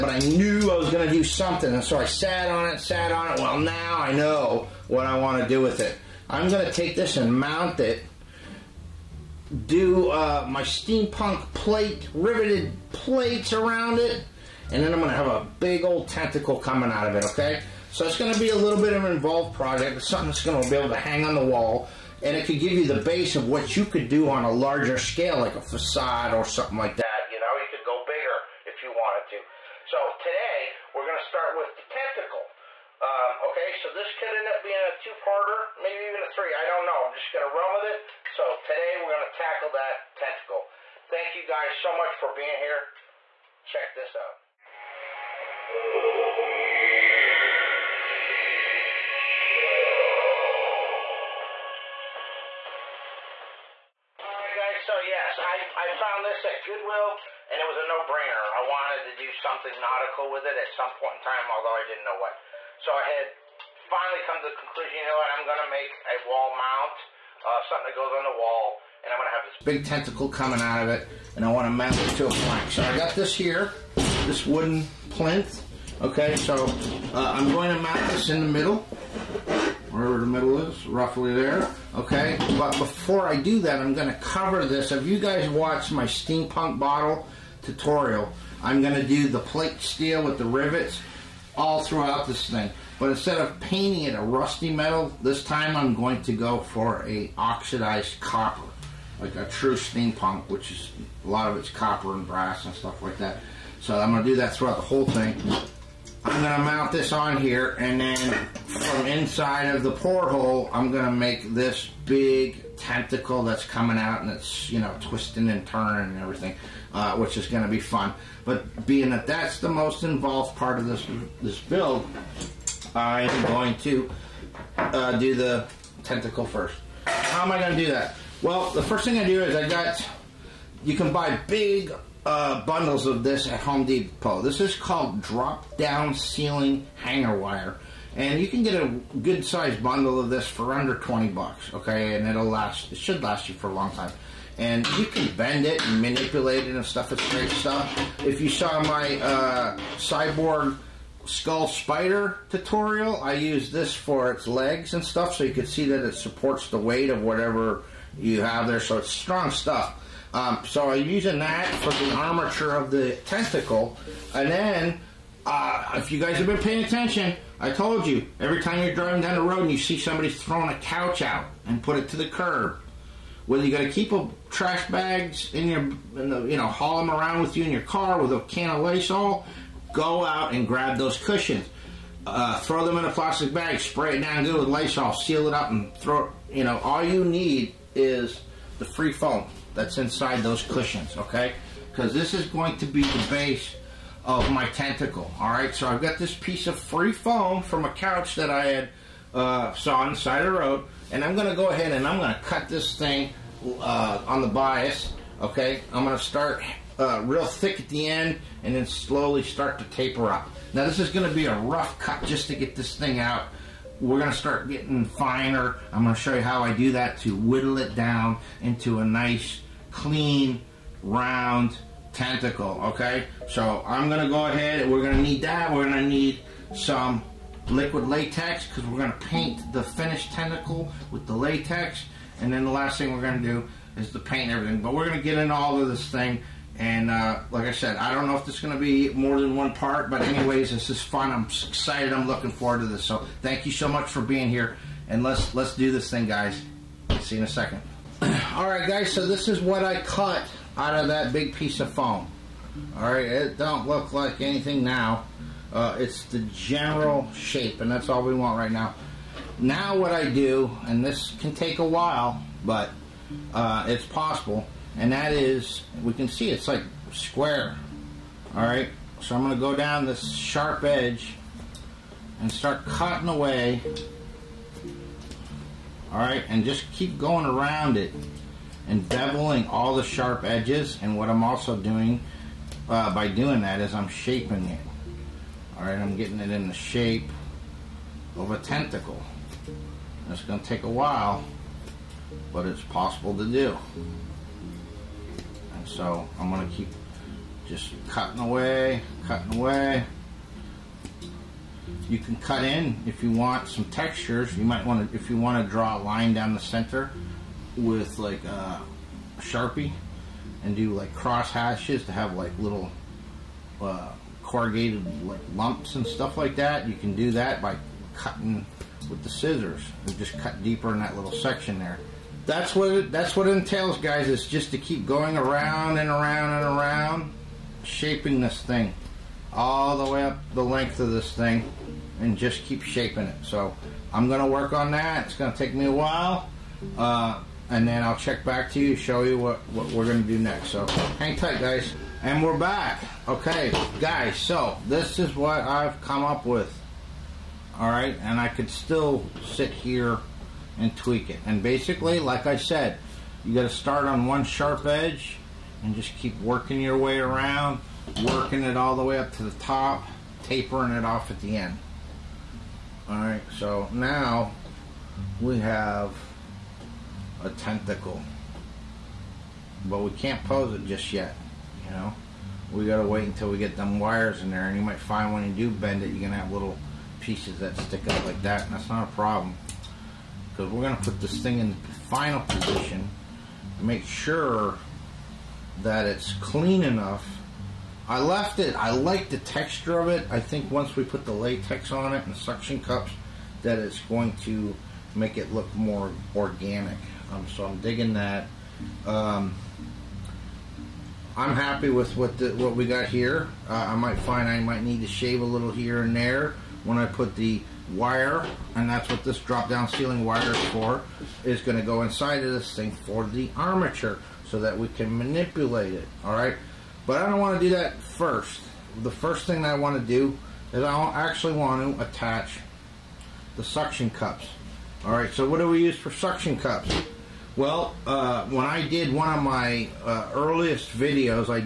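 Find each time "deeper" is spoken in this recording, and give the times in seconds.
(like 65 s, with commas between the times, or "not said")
320 s.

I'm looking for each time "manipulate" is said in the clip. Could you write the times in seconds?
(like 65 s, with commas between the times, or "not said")
146 s, 415 s.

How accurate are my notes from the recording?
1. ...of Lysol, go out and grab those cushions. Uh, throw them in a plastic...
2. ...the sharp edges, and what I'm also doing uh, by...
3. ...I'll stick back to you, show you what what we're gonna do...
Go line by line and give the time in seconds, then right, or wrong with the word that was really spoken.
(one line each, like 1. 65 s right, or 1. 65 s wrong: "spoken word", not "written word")
1. 178 s right
2. 279 s right
3. 338 s wrong: "check", not "stick".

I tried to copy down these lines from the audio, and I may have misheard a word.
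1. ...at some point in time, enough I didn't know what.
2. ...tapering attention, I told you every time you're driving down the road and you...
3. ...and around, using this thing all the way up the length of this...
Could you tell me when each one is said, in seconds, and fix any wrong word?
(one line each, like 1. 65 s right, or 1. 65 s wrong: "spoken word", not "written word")
1. 60 s wrong: "although", not "enough"
2. 166 s wrong: "paying", not "tapering"
3. 326 s wrong: "shaping", not "using".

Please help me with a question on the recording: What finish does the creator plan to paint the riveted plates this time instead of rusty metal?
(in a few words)
Oxidized copper.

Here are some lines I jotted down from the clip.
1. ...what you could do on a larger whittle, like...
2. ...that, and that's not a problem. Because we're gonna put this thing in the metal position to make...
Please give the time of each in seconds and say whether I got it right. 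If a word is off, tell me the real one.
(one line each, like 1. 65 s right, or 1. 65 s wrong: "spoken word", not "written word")
1. 23 s wrong: "scale", not "whittle"
2. 378 s wrong: "final", not "metal".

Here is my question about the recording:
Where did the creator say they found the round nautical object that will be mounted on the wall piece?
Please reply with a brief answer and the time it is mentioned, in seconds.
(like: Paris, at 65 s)
Goodwill, at 56 s.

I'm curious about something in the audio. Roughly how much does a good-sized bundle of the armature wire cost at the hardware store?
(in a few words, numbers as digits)
Under $20.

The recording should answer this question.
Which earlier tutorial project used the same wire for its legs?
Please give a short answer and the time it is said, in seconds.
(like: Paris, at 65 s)
Cyborg skull spider, at 149 s.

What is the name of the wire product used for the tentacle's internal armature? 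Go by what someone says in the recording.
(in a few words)
Drop down ceiling hanger wire.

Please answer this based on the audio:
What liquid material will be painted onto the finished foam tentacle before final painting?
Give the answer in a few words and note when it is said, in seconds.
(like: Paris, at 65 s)
Liquid latex, at 227 s.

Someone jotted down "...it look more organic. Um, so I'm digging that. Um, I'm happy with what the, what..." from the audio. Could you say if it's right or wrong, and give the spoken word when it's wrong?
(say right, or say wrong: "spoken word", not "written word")
right.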